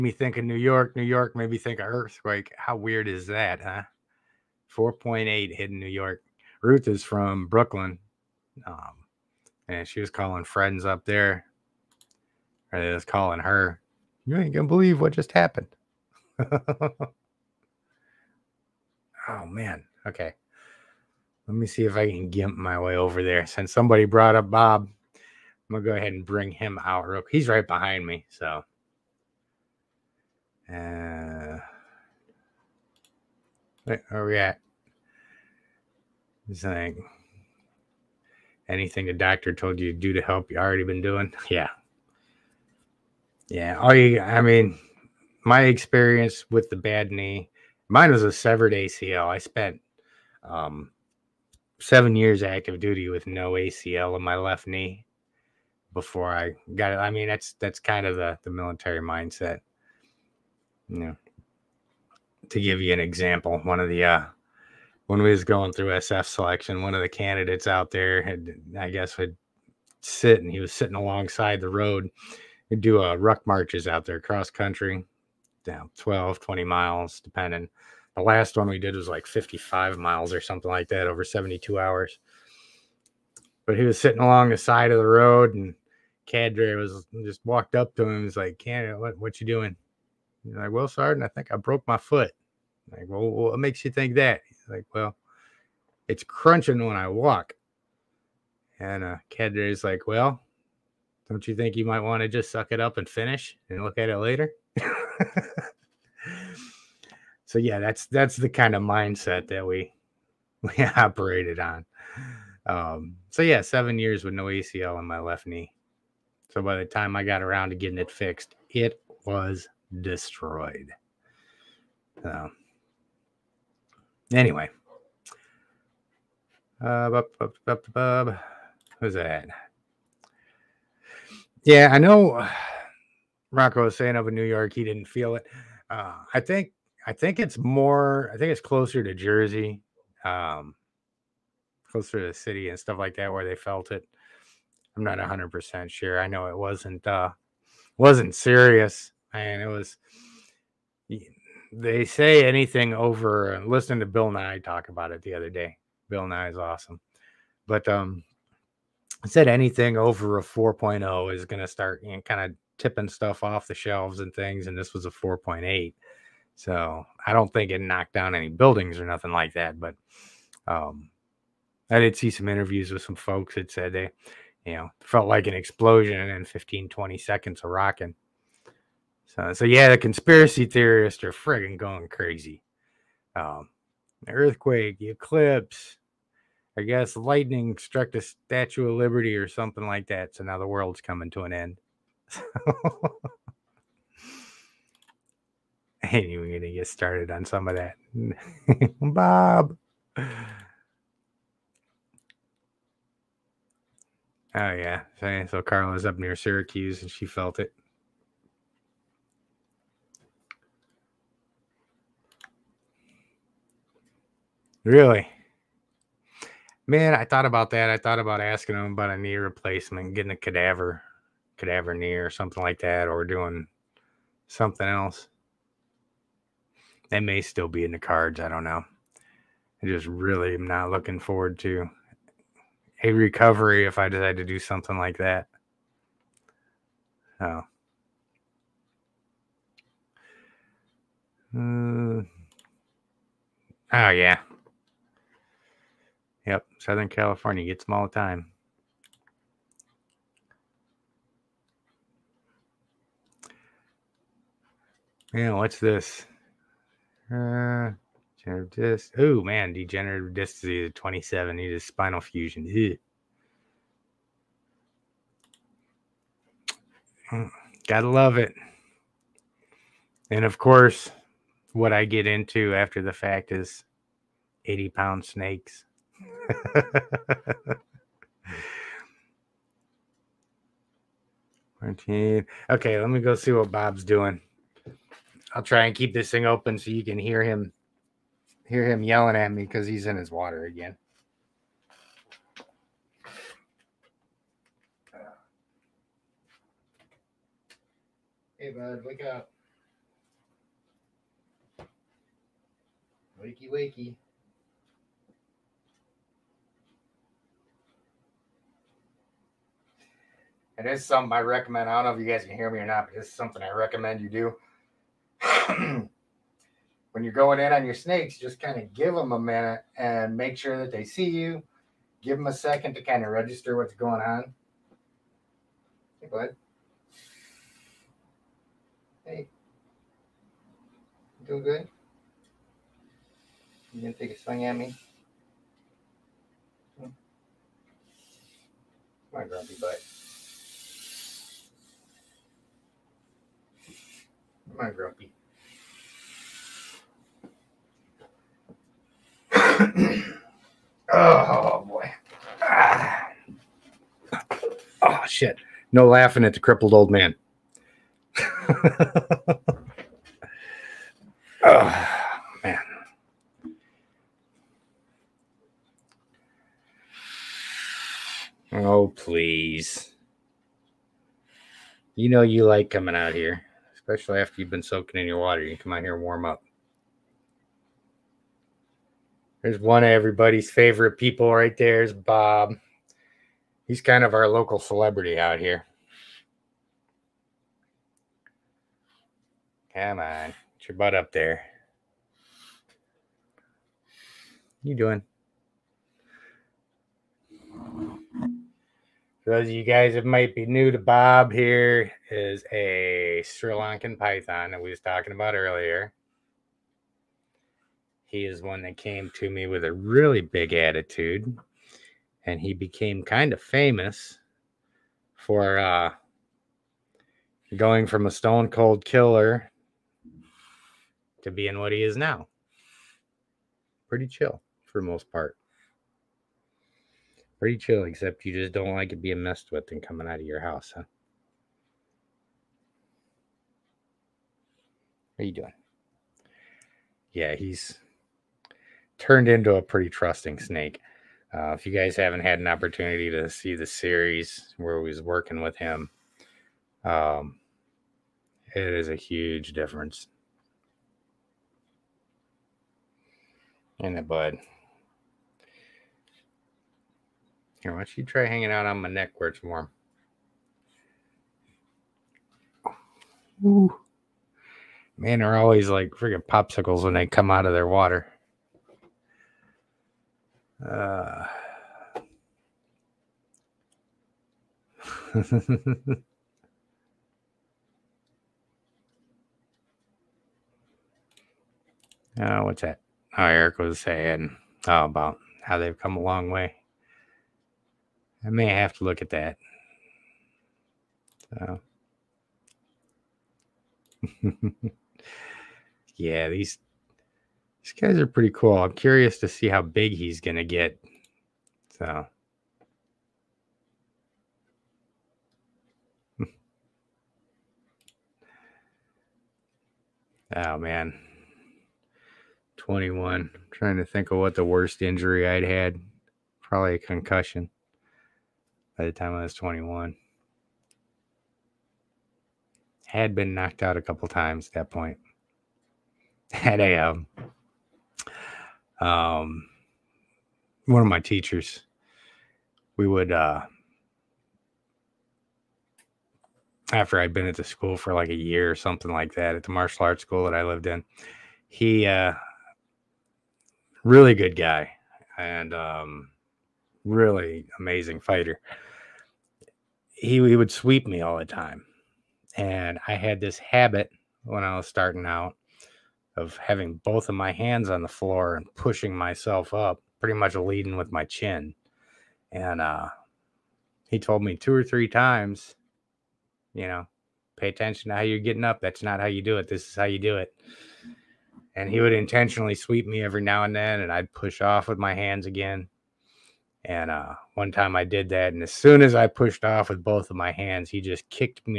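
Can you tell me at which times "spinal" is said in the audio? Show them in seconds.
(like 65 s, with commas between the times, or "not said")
261 s.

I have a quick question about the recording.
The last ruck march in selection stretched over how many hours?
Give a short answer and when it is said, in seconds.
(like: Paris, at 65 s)
72, at 81 s.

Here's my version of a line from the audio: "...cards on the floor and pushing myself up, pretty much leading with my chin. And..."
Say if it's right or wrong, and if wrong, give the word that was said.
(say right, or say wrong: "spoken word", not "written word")
wrong: "hands", not "cards".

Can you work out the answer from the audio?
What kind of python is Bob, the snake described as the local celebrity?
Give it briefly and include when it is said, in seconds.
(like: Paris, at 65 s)
Sri Lankan python, at 403 s.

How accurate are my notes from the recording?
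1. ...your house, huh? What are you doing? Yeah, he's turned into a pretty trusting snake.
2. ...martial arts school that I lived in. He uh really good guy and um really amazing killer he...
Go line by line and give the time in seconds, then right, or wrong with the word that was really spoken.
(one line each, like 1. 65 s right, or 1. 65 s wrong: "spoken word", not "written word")
1. 430 s right
2. 539 s wrong: "fighter", not "killer".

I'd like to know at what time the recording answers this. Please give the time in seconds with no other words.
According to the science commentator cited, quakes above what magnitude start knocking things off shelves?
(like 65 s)
160 s.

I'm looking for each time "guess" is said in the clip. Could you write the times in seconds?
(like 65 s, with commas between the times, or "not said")
68 s, 186 s.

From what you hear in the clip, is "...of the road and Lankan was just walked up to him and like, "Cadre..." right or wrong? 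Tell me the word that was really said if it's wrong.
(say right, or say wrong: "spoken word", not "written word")
wrong: "Cadre", not "Lankan".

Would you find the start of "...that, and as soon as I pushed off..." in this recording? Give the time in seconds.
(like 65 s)
578 s.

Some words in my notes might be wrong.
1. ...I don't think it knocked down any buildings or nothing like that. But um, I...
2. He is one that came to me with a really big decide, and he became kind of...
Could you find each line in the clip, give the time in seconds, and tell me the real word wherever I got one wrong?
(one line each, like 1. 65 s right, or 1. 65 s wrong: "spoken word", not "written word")
1. 167 s right
2. 408 s wrong: "attitude", not "decide".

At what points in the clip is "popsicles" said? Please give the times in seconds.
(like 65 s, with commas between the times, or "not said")
466 s.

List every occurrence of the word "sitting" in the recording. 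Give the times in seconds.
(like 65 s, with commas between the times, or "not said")
70 s, 83 s.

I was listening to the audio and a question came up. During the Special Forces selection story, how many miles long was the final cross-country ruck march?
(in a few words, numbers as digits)
55 miles.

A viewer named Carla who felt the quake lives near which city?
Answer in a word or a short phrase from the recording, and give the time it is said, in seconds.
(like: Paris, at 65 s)
Syracuse, at 206 s.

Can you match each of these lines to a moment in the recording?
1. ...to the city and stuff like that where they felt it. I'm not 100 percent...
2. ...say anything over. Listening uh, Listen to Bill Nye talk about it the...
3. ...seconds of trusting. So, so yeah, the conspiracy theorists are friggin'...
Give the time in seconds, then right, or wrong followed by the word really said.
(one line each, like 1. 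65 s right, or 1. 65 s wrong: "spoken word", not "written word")
1. 142 s right
2. 152 s right
3. 177 s wrong: "rocking", not "trusting".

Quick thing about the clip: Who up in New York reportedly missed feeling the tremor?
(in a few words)
Rocco.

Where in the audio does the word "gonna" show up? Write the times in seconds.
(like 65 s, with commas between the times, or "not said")
14 s, 25 s, 334 s, 500 s.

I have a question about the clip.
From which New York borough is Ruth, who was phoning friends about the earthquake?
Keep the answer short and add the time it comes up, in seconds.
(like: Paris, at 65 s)
Brooklyn, at 7 s.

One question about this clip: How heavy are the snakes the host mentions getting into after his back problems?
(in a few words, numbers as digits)
80 pounds.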